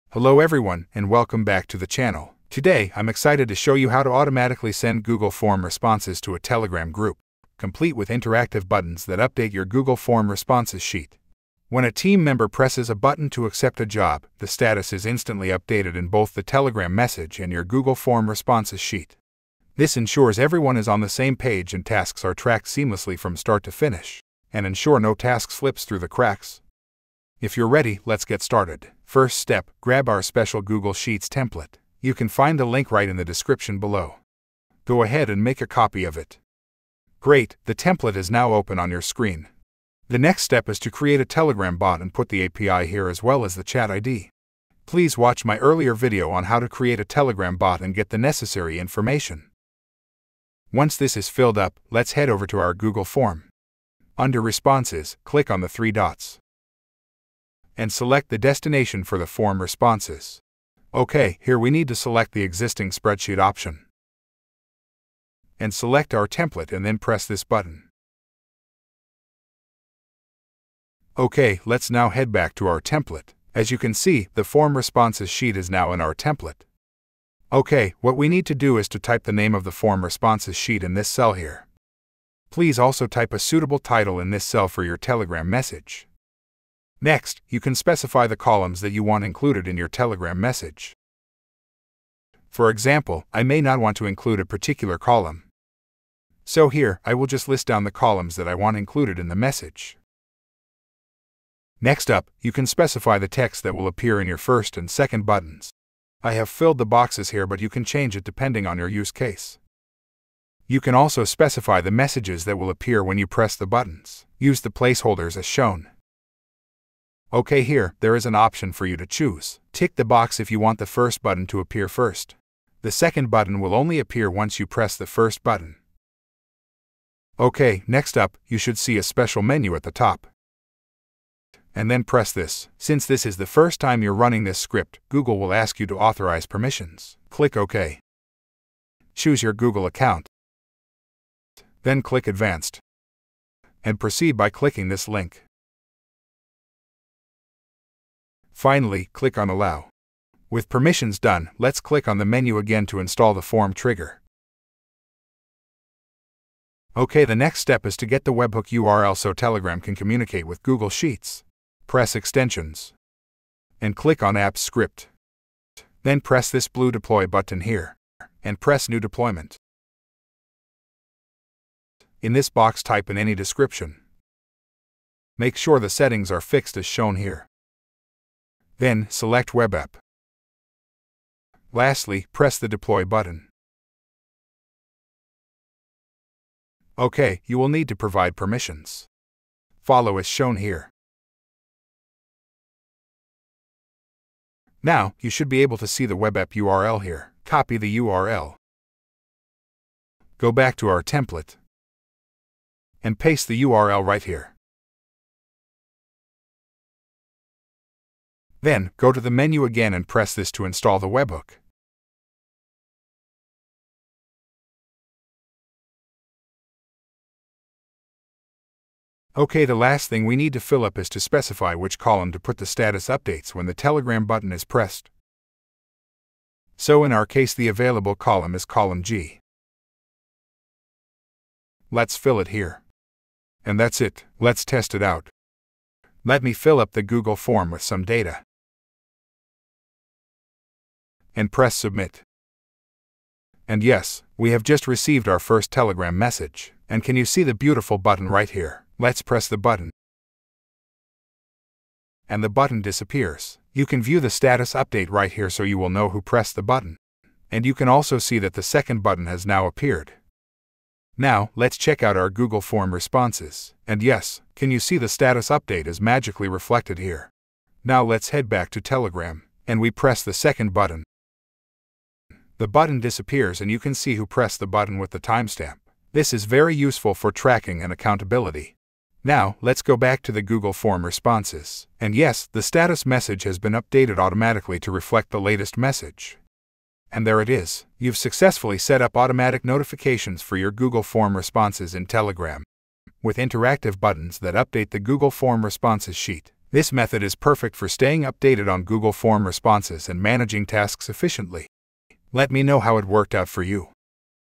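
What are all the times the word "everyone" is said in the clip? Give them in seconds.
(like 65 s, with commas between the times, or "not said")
0 s, 20 s.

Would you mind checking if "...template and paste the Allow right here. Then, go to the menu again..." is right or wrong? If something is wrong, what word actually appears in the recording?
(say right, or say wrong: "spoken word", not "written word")
wrong: "URL", not "Allow".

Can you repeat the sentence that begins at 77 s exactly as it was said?
OK, what we need to do is to type the name of the form responses sheet in this cell here.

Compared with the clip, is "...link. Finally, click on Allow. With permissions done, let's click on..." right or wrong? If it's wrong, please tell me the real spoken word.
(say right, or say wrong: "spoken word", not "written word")
right.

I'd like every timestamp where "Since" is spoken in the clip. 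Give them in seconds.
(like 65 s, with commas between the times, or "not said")
132 s.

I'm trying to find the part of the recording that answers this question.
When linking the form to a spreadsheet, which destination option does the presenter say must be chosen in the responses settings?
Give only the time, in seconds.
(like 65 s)
62 s.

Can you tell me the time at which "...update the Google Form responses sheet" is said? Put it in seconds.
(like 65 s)
294 s.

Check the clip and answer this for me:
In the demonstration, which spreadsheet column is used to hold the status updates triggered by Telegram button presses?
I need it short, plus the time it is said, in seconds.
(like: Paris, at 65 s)
Column G, at 228 s.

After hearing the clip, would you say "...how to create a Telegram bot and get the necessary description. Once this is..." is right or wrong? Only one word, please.
wrong.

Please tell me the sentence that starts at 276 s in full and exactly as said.
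This is very useful for tracking and accountability.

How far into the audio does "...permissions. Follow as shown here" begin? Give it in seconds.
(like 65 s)
188 s.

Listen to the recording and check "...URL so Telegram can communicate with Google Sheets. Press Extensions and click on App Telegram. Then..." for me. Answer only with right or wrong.
wrong.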